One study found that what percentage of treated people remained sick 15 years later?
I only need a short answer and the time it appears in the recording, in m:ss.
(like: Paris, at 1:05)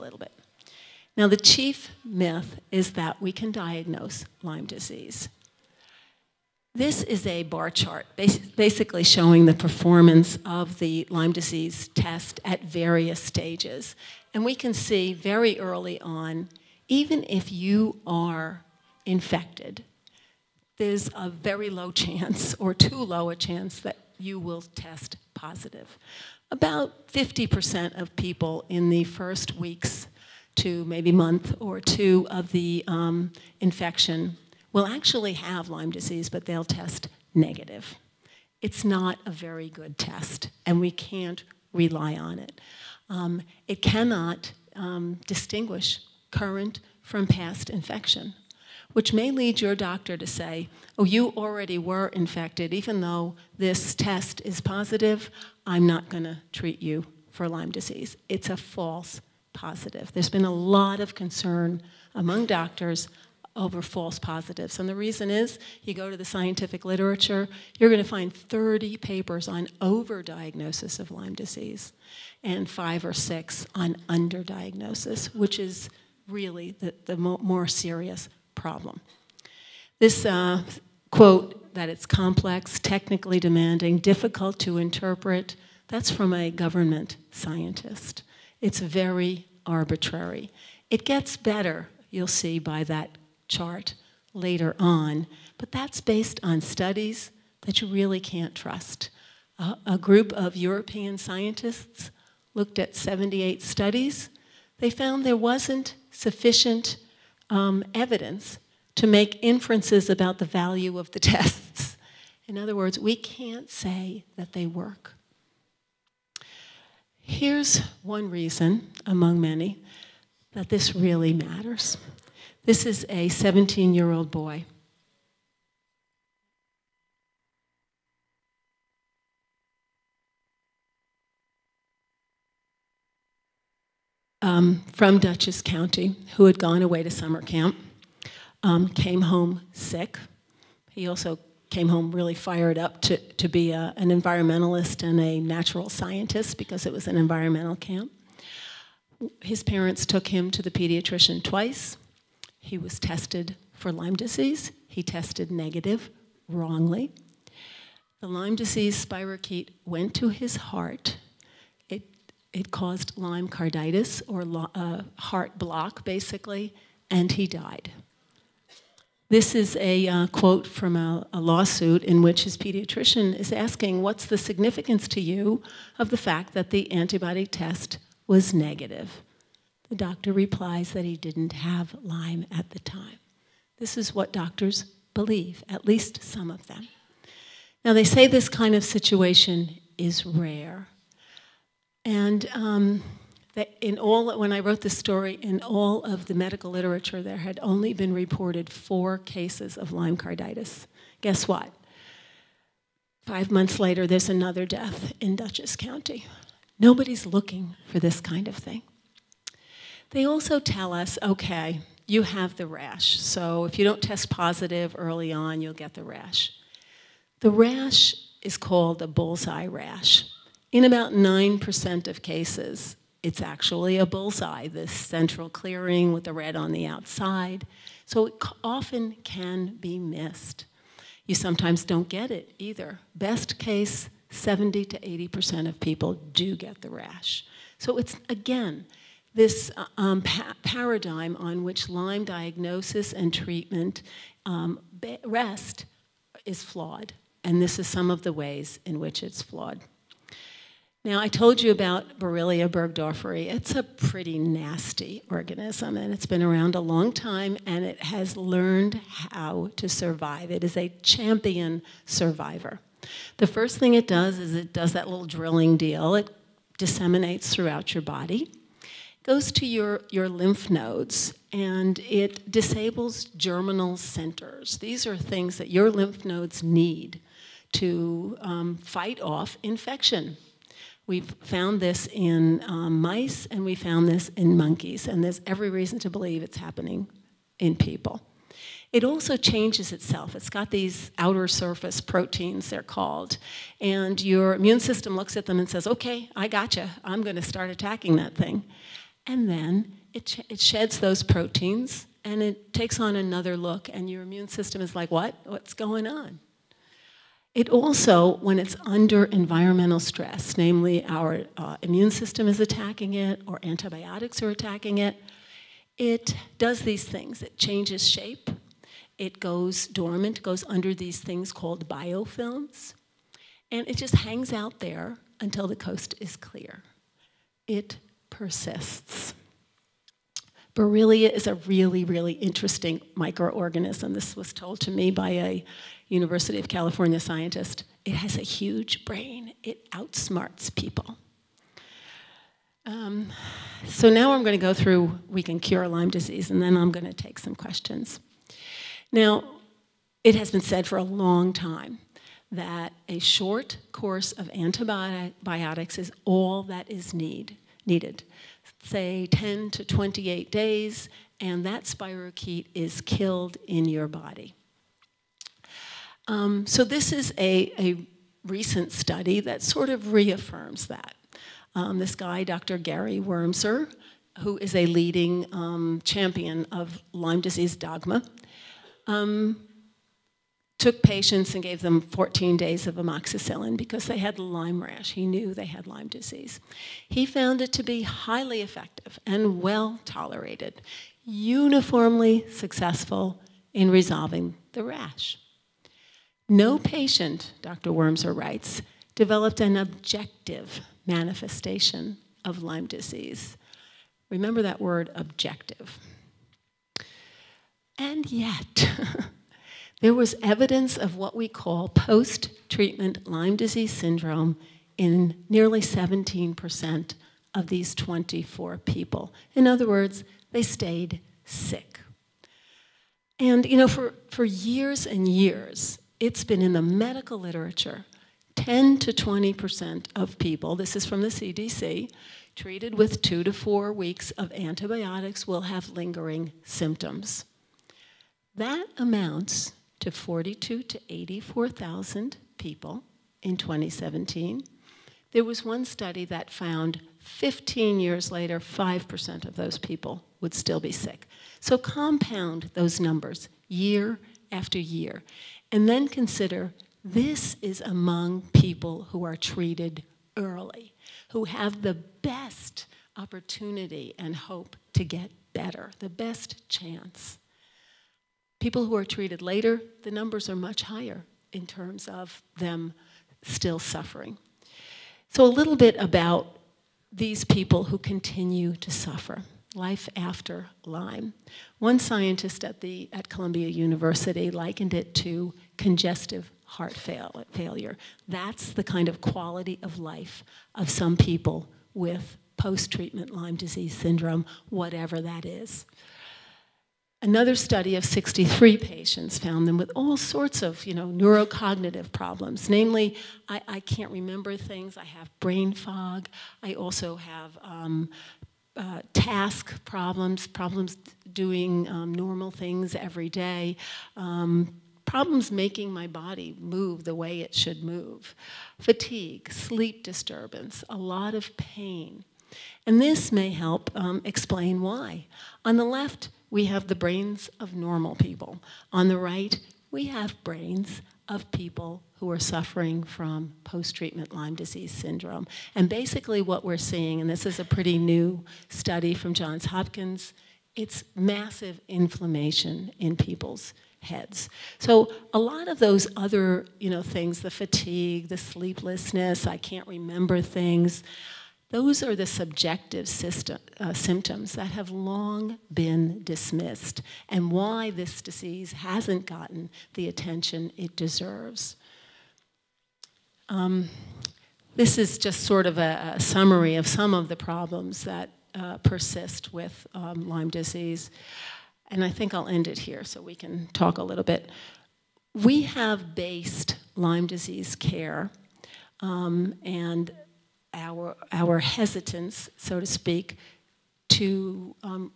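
5%, at 7:28.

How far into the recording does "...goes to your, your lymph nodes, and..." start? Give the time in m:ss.
4:29.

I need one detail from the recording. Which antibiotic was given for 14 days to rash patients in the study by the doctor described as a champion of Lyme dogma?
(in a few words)
amoxicillin.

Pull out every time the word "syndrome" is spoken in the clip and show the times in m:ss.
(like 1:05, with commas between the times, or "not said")
6:53, 8:13, 8:54.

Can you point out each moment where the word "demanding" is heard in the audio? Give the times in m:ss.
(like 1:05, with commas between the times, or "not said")
1:23.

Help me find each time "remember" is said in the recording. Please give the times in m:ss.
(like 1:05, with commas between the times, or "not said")
6:44, 8:24, 9:09.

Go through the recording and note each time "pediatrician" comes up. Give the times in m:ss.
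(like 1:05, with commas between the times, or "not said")
2:30, 2:52.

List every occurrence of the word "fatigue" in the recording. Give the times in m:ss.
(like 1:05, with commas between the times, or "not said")
8:38, 9:07.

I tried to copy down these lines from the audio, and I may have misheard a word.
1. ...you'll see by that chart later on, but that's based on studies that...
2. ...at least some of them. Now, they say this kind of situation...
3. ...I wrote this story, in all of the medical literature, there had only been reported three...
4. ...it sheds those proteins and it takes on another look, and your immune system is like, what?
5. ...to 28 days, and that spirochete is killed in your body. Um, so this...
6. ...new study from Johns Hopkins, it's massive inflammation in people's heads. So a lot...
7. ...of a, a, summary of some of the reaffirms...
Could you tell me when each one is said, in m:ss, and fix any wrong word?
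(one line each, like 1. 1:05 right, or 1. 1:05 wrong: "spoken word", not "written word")
1. 1:32 right
2. 3:05 right
3. 3:14 wrong: "four", not "three"
4. 5:00 right
5. 5:59 right
6. 8:57 right
7. 9:25 wrong: "problems", not "reaffirms".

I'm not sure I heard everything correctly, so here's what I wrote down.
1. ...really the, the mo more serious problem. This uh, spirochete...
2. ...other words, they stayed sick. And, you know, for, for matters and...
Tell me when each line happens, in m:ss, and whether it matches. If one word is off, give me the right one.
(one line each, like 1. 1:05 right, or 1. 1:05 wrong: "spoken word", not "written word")
1. 1:16 wrong: "quote", not "spirochete"
2. 6:59 wrong: "years", not "matters".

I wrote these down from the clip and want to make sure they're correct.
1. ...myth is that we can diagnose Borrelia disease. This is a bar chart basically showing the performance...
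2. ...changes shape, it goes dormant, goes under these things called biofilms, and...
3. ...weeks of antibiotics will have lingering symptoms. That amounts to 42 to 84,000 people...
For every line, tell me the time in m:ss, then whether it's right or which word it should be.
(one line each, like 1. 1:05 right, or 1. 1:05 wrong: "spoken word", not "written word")
1. 0:02 wrong: "Lyme", not "Borrelia"
2. 5:17 right
3. 7:13 right.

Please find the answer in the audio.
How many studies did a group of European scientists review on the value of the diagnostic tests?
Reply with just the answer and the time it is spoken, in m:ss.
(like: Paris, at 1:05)
78, at 1:42.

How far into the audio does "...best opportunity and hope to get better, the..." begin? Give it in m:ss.
7:41.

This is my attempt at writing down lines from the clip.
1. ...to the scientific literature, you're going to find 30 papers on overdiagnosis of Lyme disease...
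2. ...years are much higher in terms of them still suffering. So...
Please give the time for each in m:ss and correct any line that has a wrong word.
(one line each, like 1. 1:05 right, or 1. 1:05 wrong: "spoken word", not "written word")
1. 1:06 right
2. 7:50 wrong: "numbers", not "years".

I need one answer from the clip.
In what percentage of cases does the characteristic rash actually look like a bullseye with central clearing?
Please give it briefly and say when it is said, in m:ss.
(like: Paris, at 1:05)
9%, at 3:41.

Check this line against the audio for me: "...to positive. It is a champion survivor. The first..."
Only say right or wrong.
wrong.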